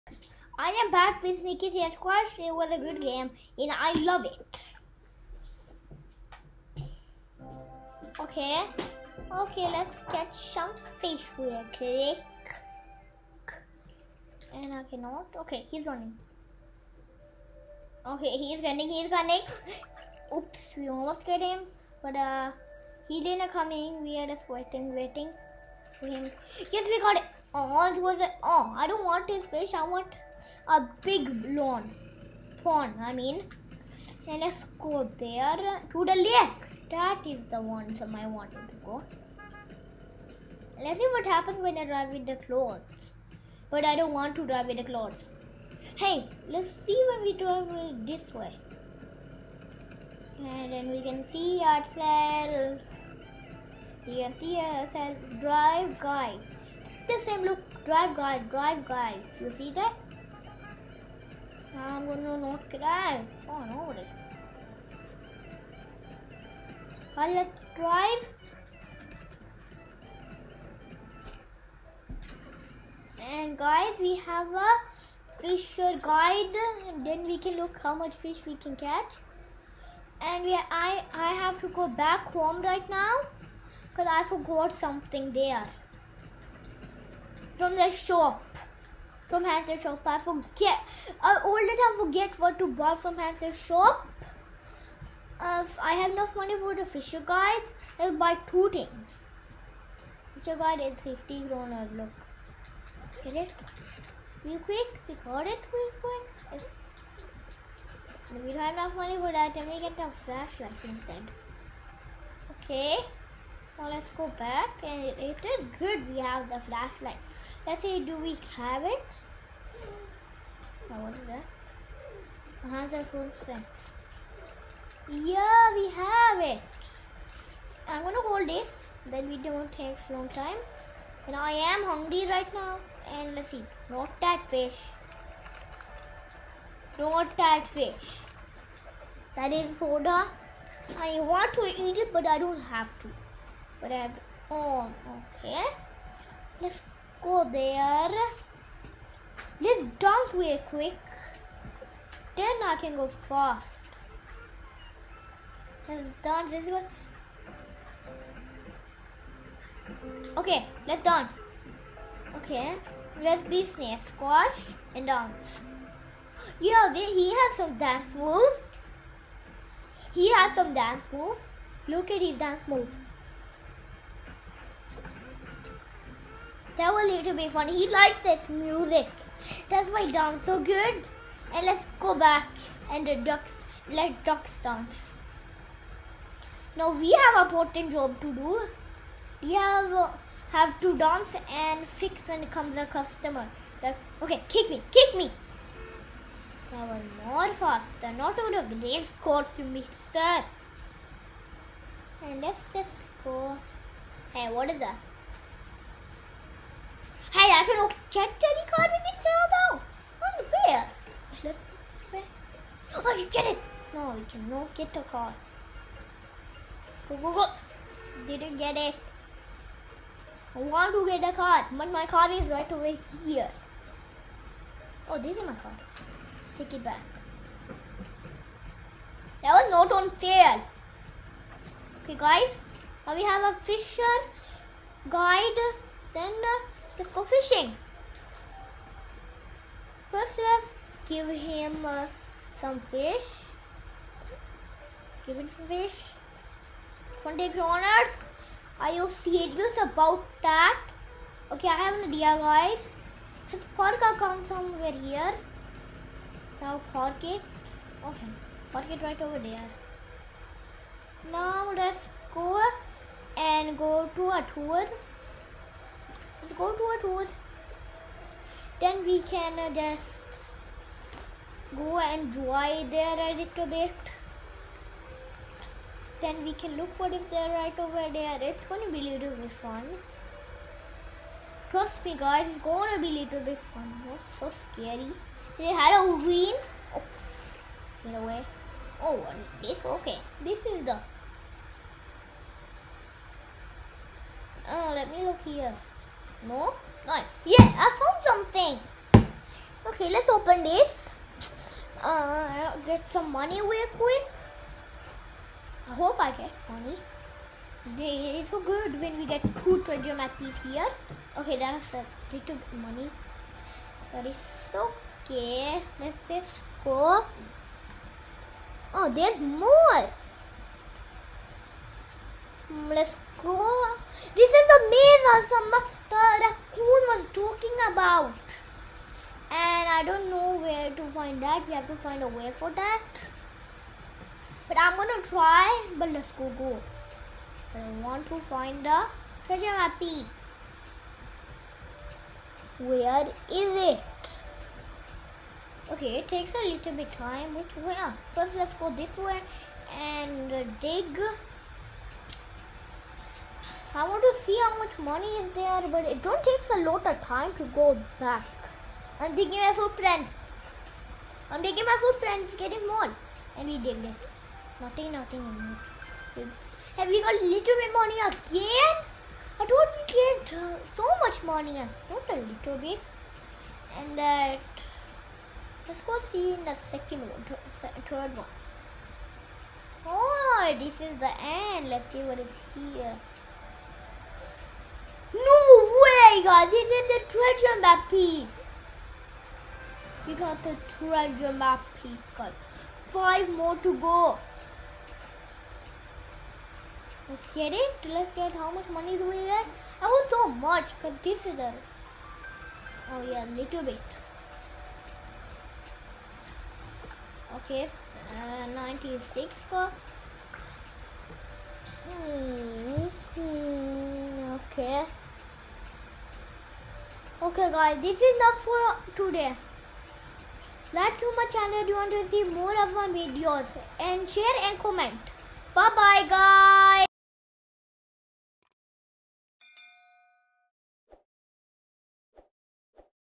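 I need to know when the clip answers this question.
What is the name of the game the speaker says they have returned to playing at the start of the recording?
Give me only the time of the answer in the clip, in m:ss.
0:01.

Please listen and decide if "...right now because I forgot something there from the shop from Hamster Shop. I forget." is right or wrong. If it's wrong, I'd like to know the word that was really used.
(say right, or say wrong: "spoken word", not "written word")
right.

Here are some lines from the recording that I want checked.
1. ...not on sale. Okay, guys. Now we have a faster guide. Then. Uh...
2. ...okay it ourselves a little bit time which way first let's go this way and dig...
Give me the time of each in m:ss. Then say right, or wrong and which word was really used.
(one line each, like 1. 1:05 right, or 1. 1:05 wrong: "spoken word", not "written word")
1. 3:49 wrong: "fisher", not "faster"
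2. 5:45 wrong: "takes", not "ourselves".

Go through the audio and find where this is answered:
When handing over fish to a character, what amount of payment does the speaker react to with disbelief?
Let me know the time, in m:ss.
4:07.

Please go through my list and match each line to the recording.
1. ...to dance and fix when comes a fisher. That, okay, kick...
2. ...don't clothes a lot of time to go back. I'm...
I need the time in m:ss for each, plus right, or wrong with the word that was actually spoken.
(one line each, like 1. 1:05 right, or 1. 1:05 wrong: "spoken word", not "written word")
1. 3:10 wrong: "customer", not "fisher"
2. 5:56 wrong: "takes", not "clothes".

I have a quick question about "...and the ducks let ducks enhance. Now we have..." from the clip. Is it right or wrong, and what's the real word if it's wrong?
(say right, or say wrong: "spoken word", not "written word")
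wrong: "dance", not "enhance".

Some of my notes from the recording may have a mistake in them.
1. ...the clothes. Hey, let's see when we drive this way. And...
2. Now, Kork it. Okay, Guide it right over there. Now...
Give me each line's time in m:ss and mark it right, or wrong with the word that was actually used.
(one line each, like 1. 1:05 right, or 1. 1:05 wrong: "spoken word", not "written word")
1. 0:44 right
2. 4:16 wrong: "Kork", not "Guide".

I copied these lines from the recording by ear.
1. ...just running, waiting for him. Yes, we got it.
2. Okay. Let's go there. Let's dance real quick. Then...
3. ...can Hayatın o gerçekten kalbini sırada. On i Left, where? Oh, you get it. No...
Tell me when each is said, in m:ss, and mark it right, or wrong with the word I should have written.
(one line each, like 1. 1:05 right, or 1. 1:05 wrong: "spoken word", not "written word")
1. 0:24 wrong: "waiting", not "running"
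2. 2:25 right
3. 3:27 right.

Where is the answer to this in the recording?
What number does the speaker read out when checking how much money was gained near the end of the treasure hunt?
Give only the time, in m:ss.
6:48.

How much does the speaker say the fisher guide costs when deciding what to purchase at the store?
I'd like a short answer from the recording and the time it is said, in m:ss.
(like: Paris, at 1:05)
50 kroner, at 1:40.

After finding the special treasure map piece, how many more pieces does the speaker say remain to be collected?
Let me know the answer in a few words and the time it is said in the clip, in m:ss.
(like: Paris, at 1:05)
5, at 6:33.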